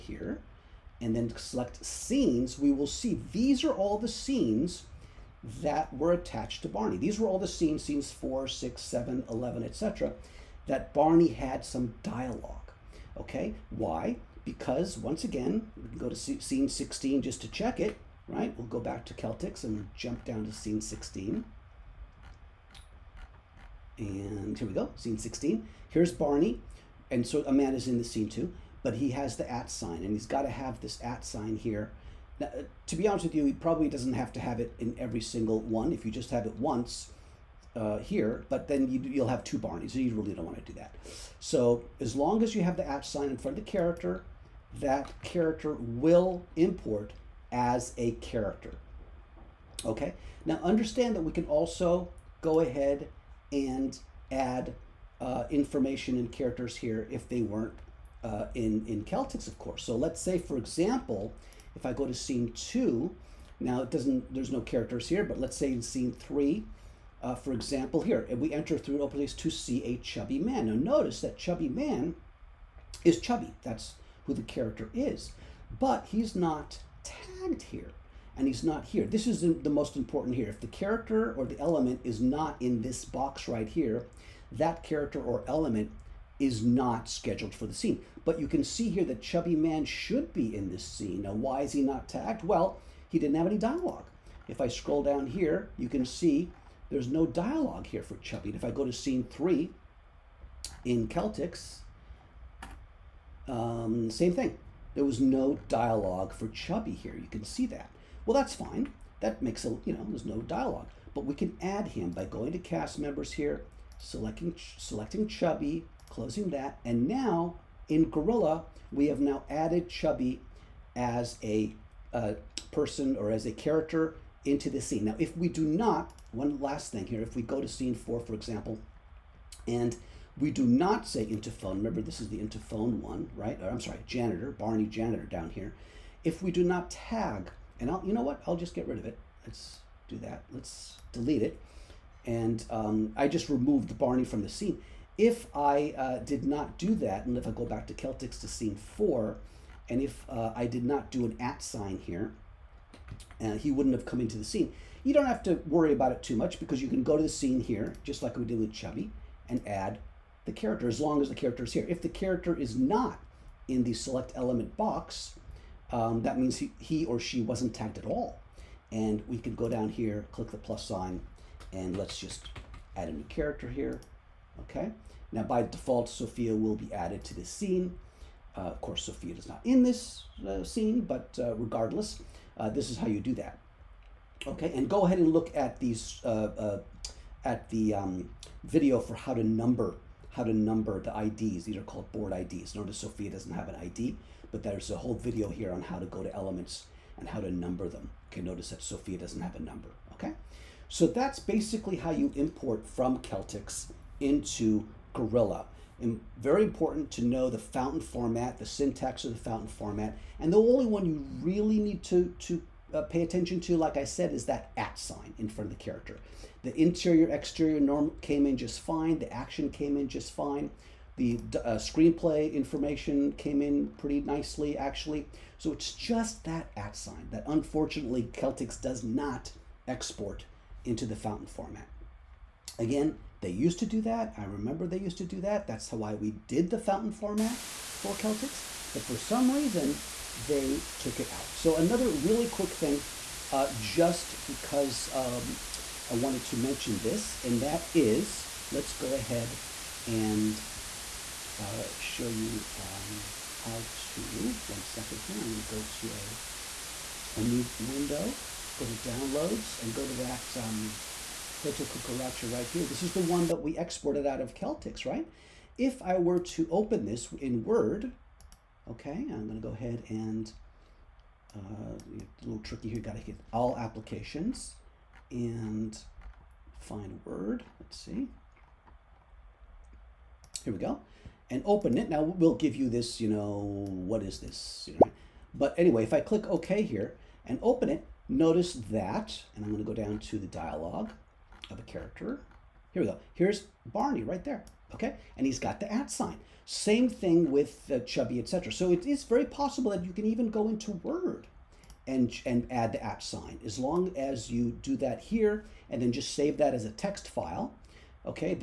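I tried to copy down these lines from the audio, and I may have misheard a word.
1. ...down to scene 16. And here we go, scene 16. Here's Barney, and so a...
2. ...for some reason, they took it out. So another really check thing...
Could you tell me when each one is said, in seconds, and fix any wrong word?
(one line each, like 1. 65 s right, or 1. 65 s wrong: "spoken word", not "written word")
1. 20 s right
2. 239 s wrong: "quick", not "check".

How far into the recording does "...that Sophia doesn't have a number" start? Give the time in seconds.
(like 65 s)
198 s.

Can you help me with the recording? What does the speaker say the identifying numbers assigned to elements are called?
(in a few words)
board IDs.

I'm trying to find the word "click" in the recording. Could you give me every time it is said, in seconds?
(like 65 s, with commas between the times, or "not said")
170 s, 286 s.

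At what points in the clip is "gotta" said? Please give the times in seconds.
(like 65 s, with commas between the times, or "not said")
273 s.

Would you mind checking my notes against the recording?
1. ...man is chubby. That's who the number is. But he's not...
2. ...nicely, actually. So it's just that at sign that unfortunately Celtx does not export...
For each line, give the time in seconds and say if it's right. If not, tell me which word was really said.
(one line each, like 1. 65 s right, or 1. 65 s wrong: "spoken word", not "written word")
1. 71 s wrong: "character", not "number"
2. 224 s right.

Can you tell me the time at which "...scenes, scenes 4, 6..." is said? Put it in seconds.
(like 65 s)
7 s.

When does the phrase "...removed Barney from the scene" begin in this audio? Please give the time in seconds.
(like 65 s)
143 s.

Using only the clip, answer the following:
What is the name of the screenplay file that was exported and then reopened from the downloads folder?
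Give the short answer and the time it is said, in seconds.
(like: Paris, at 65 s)
Hotel Cucaracha, at 261 s.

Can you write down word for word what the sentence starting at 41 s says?
So as long as you have the at sign in front of the character, that character will import as a character.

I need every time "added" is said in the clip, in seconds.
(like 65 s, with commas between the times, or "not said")
119 s, 176 s.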